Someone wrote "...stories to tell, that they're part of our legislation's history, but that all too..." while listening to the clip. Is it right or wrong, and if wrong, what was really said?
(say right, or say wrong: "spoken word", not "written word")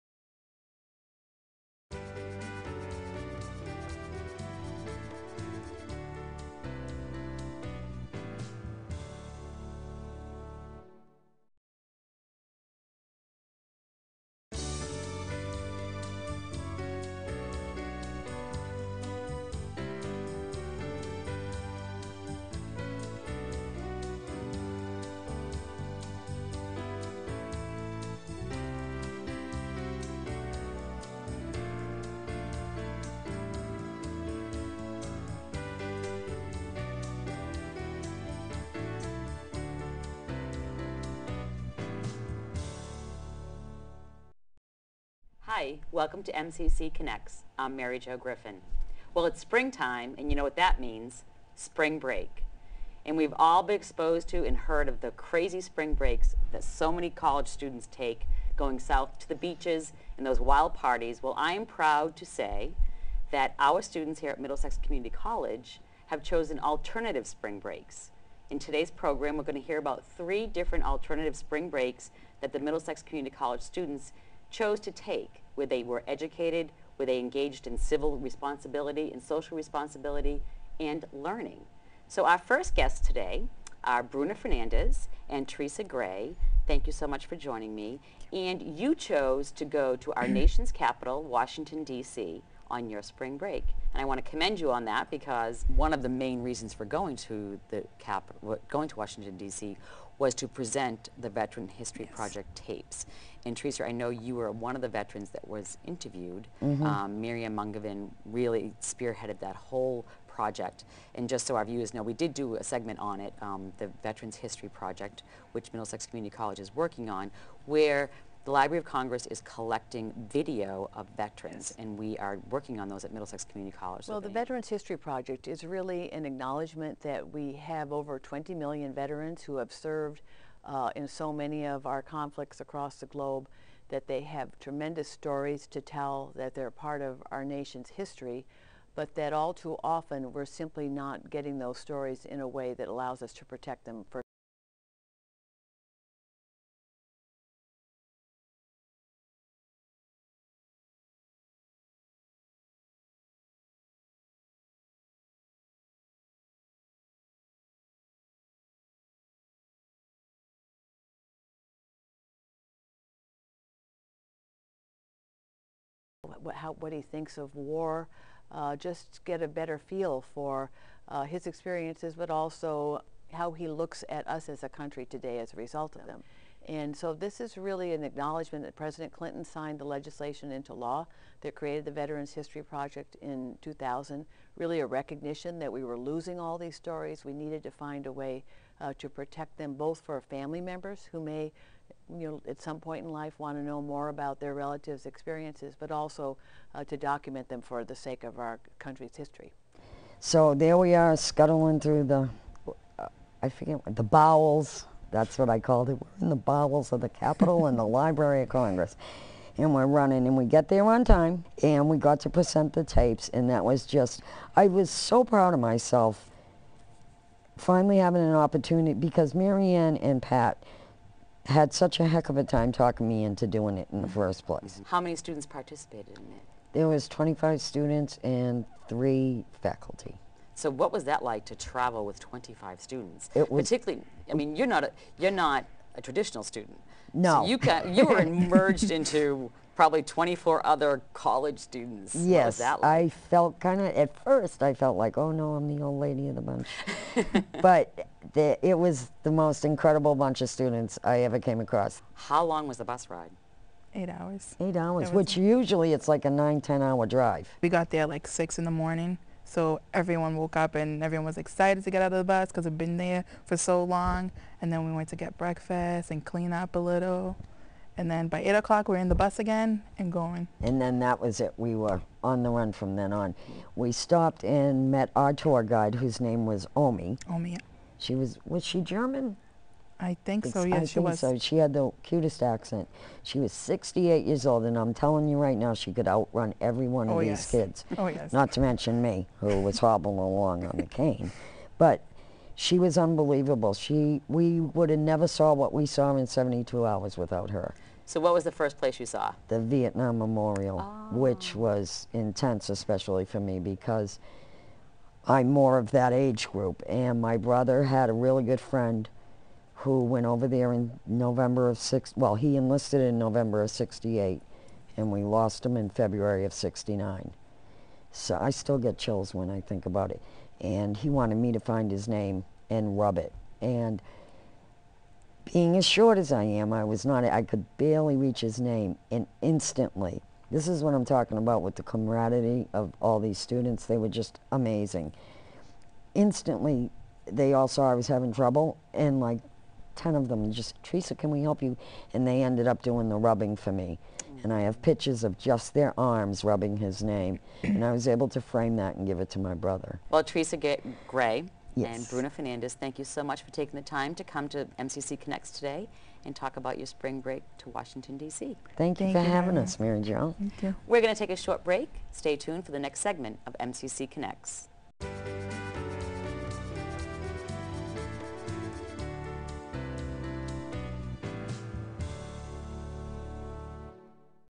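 wrong: "nation", not "legislation".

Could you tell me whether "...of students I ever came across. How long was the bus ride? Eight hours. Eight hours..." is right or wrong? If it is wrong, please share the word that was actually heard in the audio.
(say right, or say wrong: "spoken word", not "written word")
right.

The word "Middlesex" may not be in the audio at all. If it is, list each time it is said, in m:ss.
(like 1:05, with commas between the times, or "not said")
1:04, 1:12, 1:55, 2:03.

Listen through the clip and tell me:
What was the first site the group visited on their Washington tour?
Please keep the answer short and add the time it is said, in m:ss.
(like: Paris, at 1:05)
The Vietnam Memorial, at 4:59.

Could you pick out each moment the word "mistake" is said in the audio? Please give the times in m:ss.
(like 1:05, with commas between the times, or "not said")
not said.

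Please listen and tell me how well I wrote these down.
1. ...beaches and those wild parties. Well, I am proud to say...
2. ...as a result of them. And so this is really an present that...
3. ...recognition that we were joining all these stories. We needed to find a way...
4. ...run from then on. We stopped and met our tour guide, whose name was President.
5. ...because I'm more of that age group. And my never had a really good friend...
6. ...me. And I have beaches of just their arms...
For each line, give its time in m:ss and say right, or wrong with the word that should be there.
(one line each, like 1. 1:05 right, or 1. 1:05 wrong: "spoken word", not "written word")
1. 0:59 right
2. 2:55 wrong: "acknowledgement", not "present"
3. 3:04 wrong: "losing", not "joining"
4. 4:32 wrong: "Omi", not "President"
5. 5:03 wrong: "brother", not "never"
6. 5:43 wrong: "pictures", not "beaches".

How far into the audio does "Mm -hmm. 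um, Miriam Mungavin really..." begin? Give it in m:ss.
1:46.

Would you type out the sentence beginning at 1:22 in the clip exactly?
So our first guests today are Bruna Fernandez and Teresa Gray.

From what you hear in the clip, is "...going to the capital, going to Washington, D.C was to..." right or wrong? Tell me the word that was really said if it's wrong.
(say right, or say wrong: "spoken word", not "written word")
right.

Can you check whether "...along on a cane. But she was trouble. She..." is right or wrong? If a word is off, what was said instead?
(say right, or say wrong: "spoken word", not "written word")
wrong: "unbelievable", not "trouble".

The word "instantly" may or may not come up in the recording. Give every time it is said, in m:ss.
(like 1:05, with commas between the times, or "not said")
5:29, 5:36.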